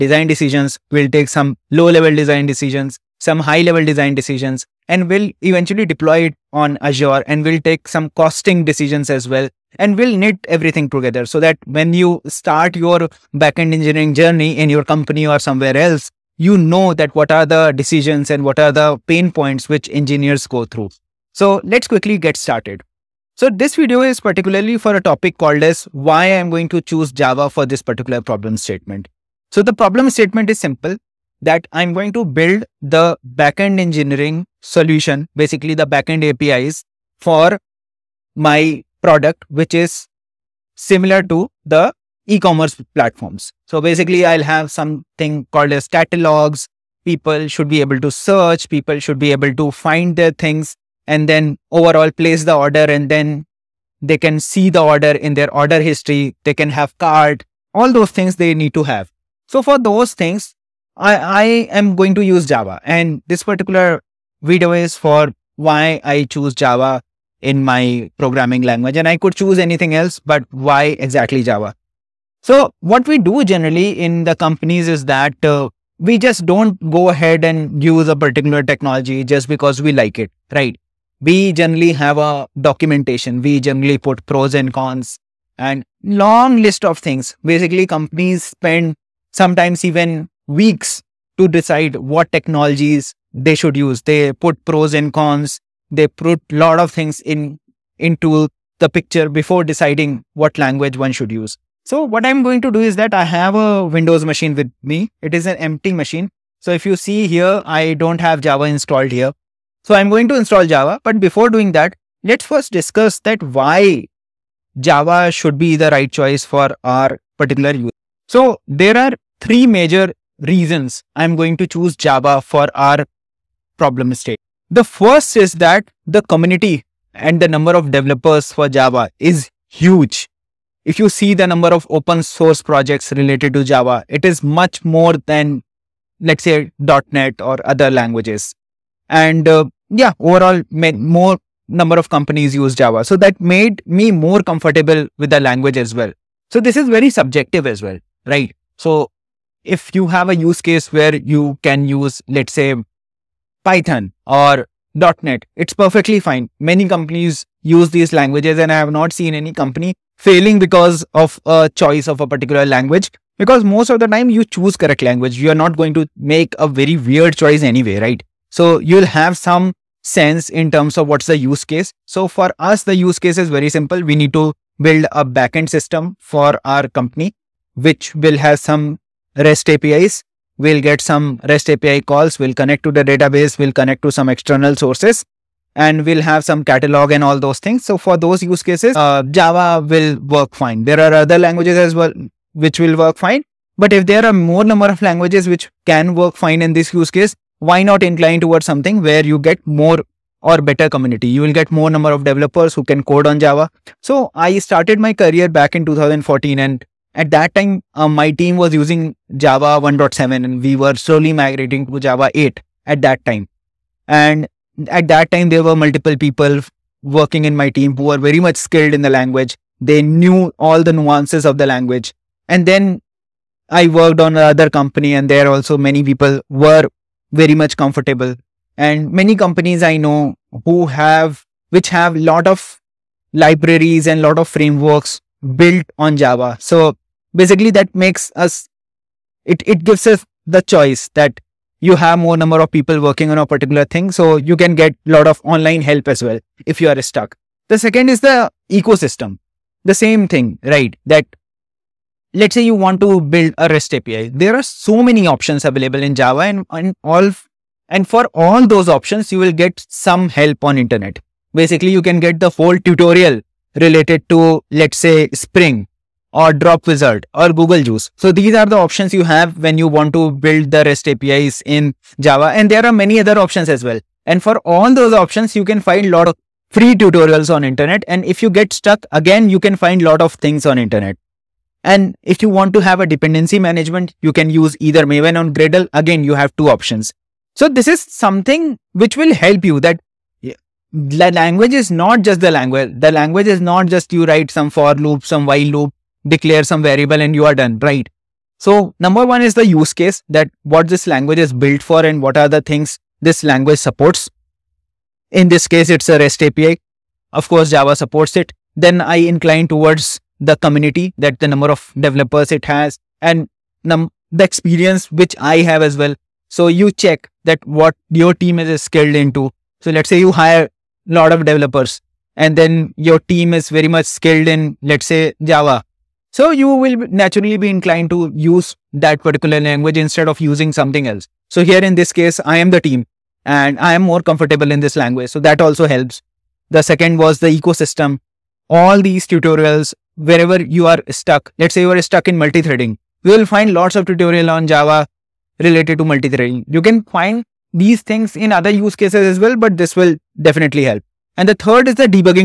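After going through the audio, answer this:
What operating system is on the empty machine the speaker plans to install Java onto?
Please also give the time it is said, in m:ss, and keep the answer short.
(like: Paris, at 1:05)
Windows, at 1:43.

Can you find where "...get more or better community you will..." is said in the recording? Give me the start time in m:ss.
3:19.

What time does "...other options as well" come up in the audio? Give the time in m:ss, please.
4:33.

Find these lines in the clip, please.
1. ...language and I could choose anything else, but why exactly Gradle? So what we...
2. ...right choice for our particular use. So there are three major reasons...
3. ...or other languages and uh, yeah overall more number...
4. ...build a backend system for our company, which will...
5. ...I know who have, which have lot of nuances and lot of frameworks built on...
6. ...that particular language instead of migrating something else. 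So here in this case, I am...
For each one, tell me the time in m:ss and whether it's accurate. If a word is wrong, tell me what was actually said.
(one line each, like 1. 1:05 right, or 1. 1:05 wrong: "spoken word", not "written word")
1. 1:08 wrong: "Java", not "Gradle"
2. 1:55 right
3. 2:17 right
4. 2:54 right
5. 3:49 wrong: "libraries", not "nuances"
6. 5:28 wrong: "using", not "migrating".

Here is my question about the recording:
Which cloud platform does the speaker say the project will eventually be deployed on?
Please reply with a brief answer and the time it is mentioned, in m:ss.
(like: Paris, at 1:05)
Azure, at 0:06.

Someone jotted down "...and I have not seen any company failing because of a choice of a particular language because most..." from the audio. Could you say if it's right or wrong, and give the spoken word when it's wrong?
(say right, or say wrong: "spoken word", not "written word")
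right.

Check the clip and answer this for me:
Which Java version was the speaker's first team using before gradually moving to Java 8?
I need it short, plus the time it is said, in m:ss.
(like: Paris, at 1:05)
Java 1.7, at 3:29.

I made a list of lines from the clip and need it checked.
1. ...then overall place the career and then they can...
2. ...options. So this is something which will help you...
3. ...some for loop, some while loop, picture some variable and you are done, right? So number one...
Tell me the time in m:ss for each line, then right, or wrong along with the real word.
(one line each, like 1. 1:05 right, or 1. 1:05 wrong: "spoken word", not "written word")
1. 0:51 wrong: "order", not "career"
2. 4:46 right
3. 4:54 wrong: "declare", not "picture".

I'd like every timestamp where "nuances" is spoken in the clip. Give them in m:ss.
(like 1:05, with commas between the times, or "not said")
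3:41.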